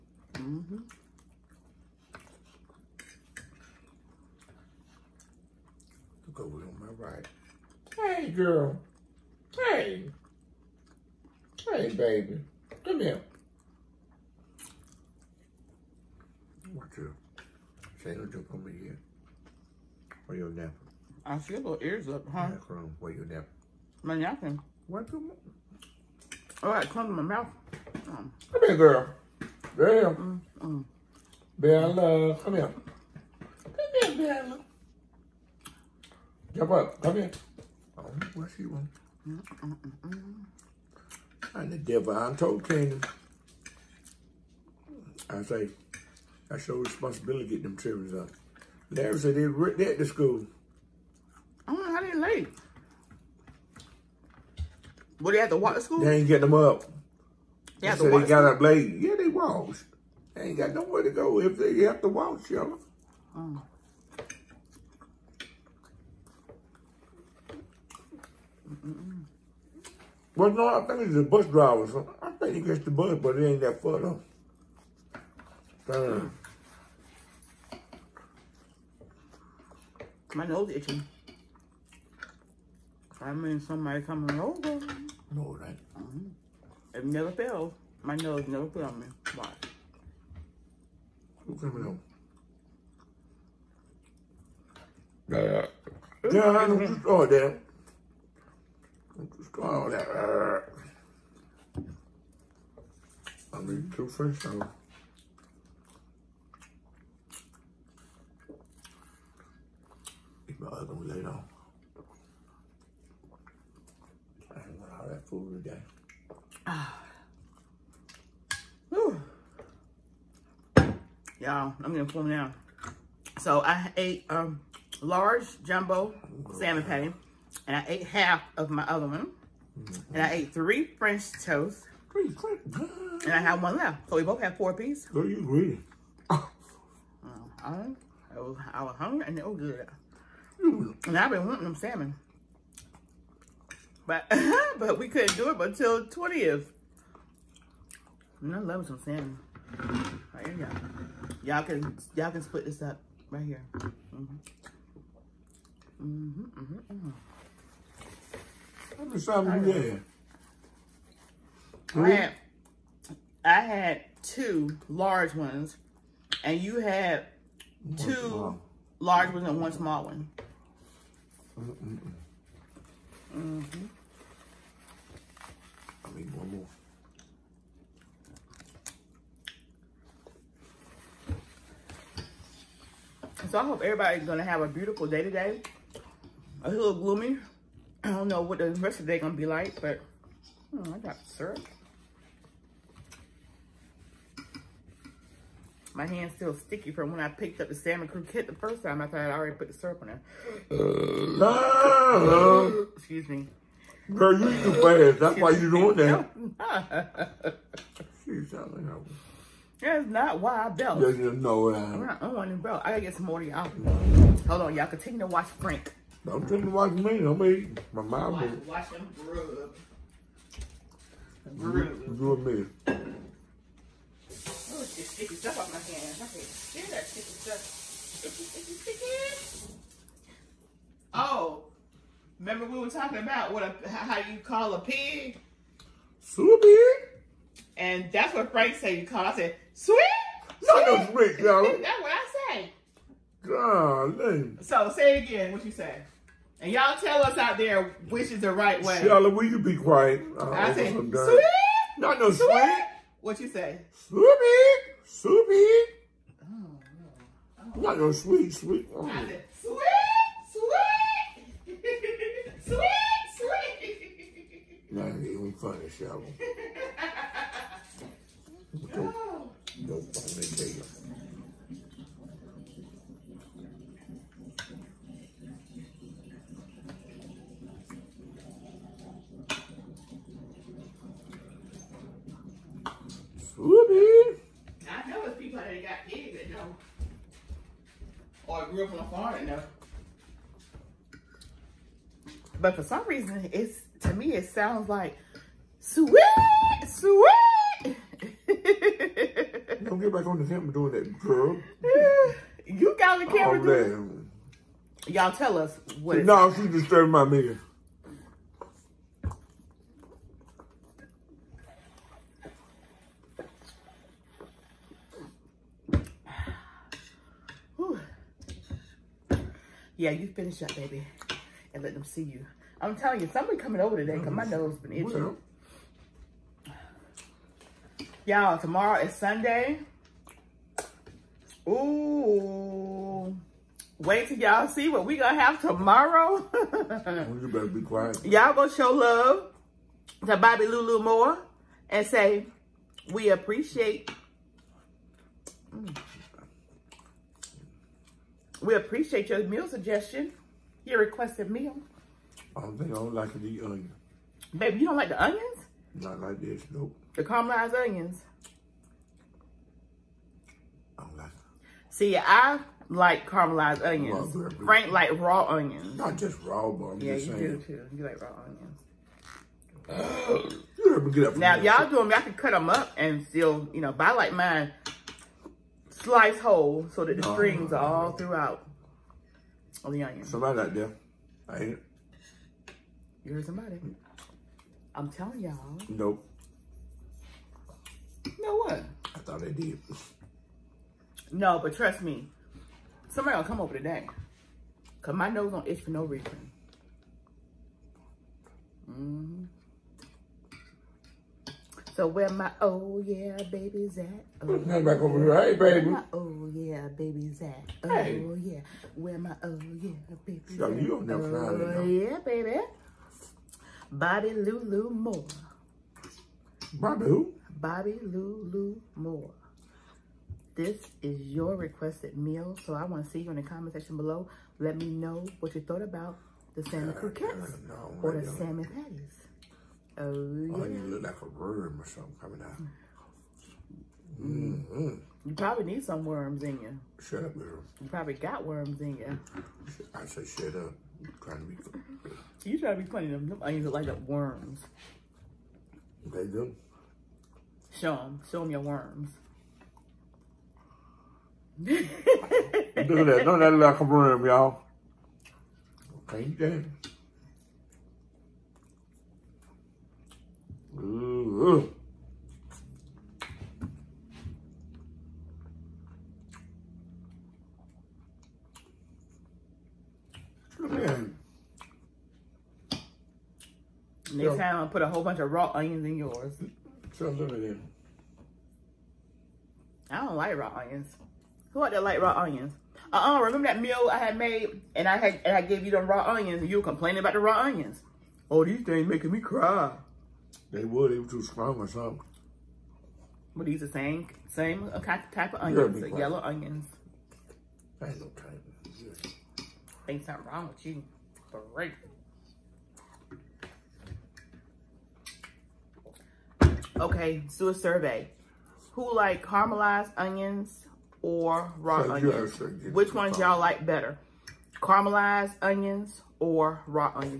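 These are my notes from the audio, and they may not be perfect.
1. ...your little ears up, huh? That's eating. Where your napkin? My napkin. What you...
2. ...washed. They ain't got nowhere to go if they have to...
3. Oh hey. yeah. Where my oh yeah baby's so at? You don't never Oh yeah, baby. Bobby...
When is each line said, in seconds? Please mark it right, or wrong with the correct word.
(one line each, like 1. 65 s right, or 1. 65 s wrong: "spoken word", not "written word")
1. 21 s wrong: "wrong", not "eating"
2. 59 s right
3. 407 s right.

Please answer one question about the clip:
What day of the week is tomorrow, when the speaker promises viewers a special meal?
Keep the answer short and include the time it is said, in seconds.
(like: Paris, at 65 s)
Sunday, at 329 s.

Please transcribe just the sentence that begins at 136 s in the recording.
Uh, I, I was hungry and it was good.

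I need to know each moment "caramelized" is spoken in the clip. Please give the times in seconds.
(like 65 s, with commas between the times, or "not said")
357 s, 363 s, 509 s, 514 s.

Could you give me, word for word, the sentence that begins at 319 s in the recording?
Yeah, you finish up, baby, and let them see you.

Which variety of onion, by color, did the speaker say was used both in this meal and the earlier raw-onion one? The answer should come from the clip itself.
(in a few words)
yellow onions.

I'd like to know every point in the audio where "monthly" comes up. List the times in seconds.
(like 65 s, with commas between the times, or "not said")
not said.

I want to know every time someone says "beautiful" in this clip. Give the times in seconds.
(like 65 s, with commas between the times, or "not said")
184 s.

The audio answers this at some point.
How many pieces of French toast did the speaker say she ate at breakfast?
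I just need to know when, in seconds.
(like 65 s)
130 s.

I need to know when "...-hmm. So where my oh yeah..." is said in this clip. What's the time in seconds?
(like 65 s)
398 s.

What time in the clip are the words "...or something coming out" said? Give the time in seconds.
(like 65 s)
431 s.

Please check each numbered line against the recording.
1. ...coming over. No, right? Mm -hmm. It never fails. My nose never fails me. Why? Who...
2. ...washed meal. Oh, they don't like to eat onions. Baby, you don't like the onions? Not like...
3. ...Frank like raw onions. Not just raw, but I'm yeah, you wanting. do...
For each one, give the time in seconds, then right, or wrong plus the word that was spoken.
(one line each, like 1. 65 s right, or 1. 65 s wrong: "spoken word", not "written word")
1. 84 s right
2. 350 s wrong: "requested", not "washed"
3. 364 s wrong: "saying", not "wanting".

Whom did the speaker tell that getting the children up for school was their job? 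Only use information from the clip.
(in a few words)
Canaan.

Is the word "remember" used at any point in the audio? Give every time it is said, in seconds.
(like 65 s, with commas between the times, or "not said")
232 s, 483 s.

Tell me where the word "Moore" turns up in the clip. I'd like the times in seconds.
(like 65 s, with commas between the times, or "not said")
341 s, 414 s, 418 s.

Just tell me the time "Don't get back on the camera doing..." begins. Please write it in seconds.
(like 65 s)
299 s.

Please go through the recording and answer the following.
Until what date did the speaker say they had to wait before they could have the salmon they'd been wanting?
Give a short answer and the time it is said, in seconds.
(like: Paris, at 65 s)
20th, at 146 s.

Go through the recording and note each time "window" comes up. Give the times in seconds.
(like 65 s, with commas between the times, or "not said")
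not said.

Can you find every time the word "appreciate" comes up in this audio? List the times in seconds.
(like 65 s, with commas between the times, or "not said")
343 s, 348 s.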